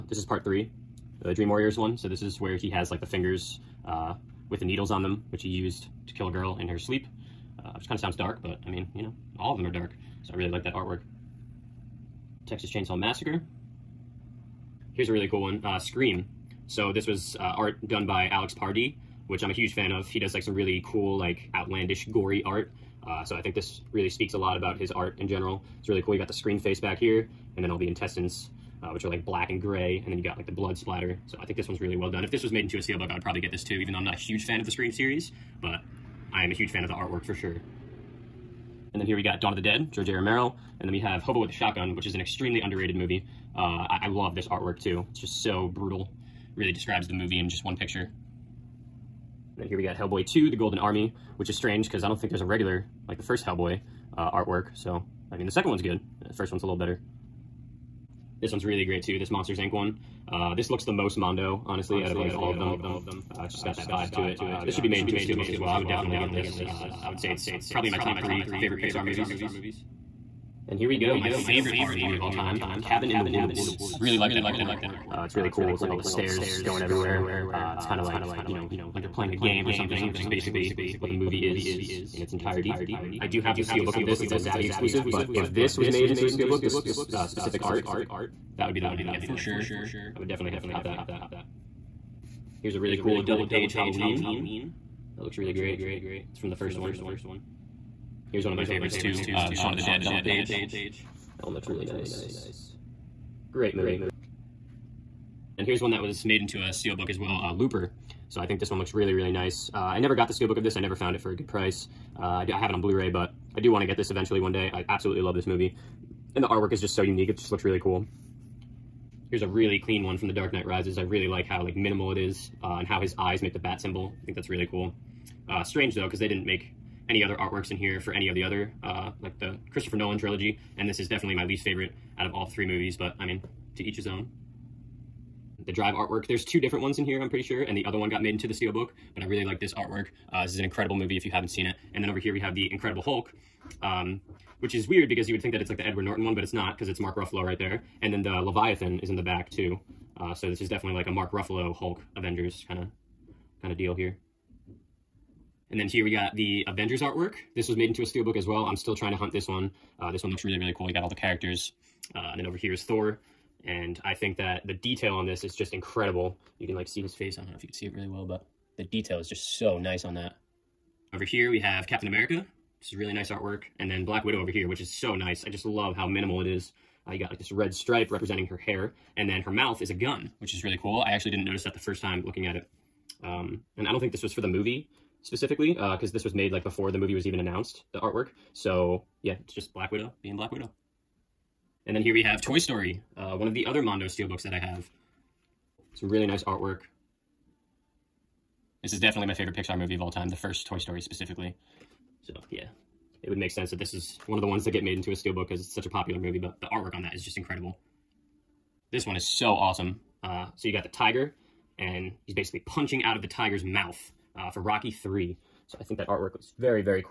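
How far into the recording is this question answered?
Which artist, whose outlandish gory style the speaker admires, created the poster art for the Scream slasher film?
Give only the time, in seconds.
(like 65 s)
18 s.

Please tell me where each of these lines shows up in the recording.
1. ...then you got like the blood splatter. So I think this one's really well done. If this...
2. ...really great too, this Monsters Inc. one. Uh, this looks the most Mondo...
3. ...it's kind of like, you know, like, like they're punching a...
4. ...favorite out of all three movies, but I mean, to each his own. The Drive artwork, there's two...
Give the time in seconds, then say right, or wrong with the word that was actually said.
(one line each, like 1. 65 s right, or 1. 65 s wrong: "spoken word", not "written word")
1. 30 s right
2. 58 s right
3. 77 s wrong: "playing", not "punching"
4. 131 s right.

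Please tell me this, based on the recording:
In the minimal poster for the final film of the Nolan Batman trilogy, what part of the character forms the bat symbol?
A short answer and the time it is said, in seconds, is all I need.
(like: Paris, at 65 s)
His eyes, at 123 s.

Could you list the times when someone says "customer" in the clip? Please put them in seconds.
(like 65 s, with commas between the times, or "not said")
not said.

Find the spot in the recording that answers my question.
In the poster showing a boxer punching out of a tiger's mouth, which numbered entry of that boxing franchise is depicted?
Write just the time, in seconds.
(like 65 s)
214 s.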